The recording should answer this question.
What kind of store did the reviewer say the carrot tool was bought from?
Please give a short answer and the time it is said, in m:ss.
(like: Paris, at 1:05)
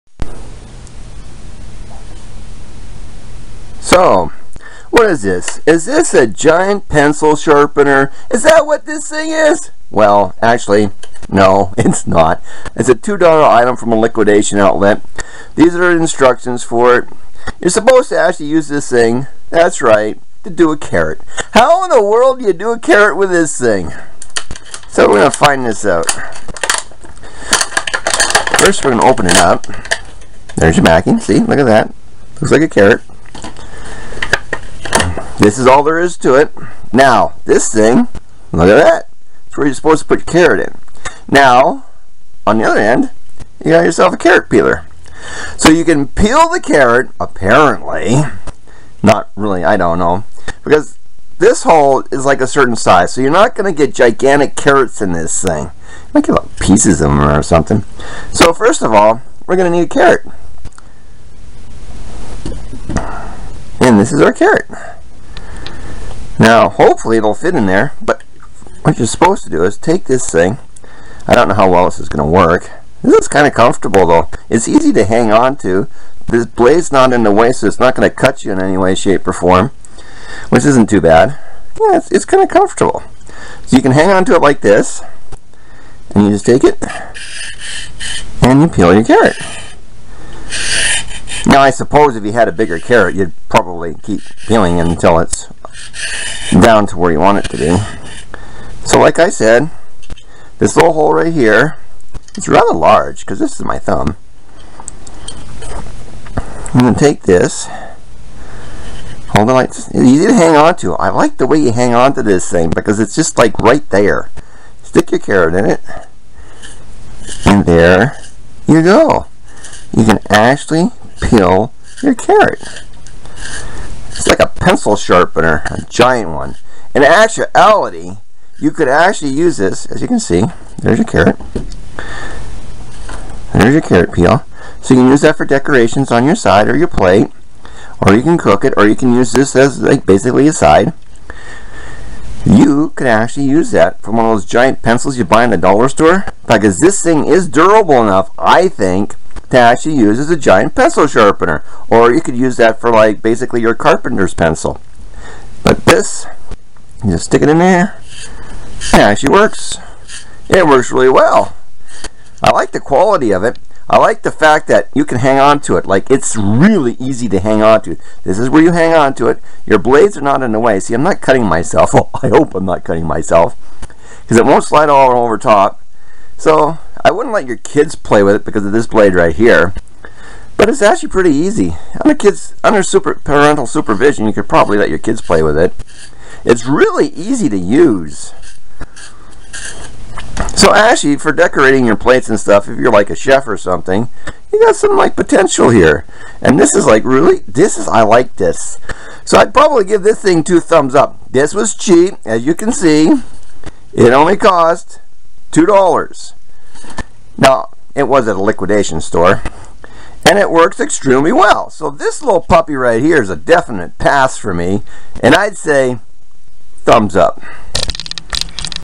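liquidation outlet, at 0:13.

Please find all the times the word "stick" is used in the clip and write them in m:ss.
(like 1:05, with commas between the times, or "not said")
1:54, 2:37.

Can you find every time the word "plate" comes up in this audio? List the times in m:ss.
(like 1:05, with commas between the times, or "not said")
2:16, 3:11.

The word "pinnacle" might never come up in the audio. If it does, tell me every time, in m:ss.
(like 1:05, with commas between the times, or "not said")
not said.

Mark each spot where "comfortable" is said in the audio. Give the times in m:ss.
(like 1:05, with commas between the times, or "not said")
1:13, 1:22.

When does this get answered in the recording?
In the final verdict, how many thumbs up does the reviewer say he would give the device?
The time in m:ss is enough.
3:20.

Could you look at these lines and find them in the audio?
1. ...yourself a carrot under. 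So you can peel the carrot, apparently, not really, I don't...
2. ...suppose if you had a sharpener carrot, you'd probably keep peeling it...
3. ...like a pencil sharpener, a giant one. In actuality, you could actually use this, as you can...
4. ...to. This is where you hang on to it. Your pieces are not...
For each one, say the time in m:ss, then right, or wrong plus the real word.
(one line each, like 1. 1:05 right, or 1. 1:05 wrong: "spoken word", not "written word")
1. 0:43 wrong: "peeler", not "under"
2. 1:31 wrong: "bigger", not "sharpener"
3. 2:04 right
4. 2:47 wrong: "blades", not "pieces".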